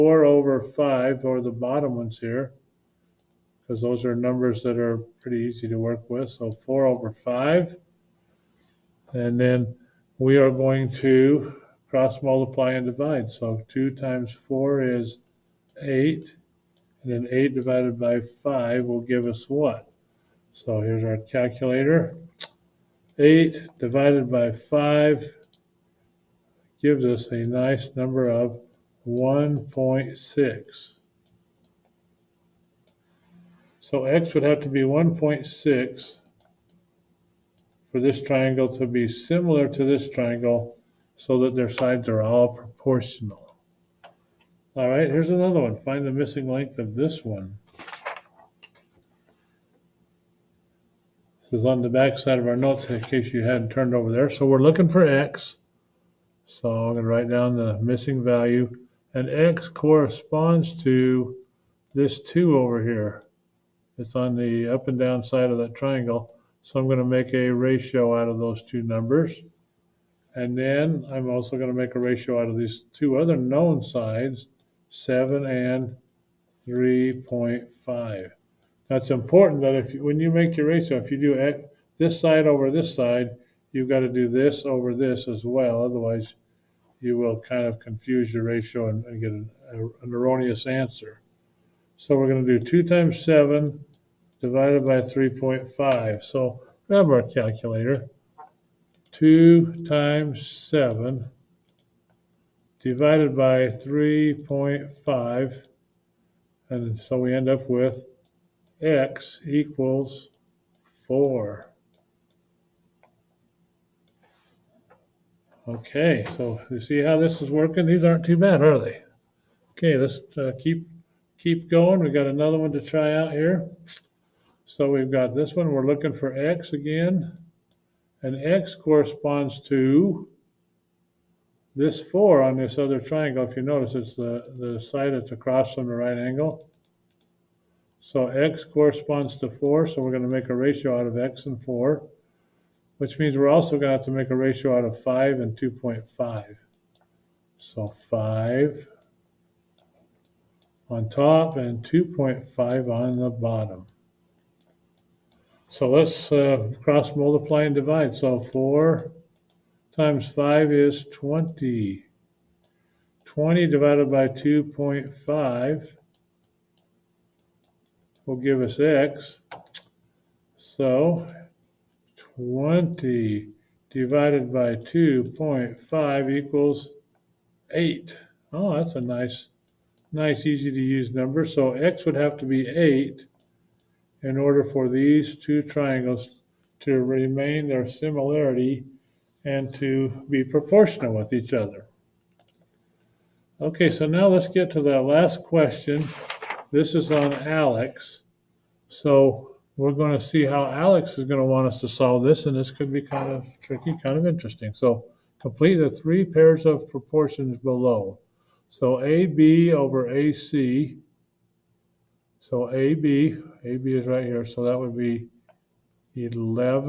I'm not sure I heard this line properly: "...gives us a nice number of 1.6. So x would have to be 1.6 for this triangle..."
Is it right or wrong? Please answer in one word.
right.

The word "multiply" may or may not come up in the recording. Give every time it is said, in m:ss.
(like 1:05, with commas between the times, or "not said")
0:12, 2:37.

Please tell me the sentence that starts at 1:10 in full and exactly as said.
And then I'm also going to make a ratio out of these two other known sides, 7 and 3.5.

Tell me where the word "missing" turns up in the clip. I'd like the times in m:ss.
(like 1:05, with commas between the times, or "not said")
0:46, 0:57.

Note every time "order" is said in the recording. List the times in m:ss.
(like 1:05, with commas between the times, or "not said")
3:04.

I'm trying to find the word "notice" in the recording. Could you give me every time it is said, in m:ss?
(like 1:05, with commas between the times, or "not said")
2:13.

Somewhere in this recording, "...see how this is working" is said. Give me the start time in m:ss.
1:56.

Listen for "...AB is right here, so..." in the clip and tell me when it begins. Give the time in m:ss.
3:33.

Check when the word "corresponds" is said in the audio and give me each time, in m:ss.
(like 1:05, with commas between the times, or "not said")
0:59, 2:08, 2:18.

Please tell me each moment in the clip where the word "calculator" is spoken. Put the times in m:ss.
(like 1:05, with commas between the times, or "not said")
0:21, 1:37.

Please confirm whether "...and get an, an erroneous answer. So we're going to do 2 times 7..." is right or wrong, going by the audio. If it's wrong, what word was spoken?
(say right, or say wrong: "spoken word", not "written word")
right.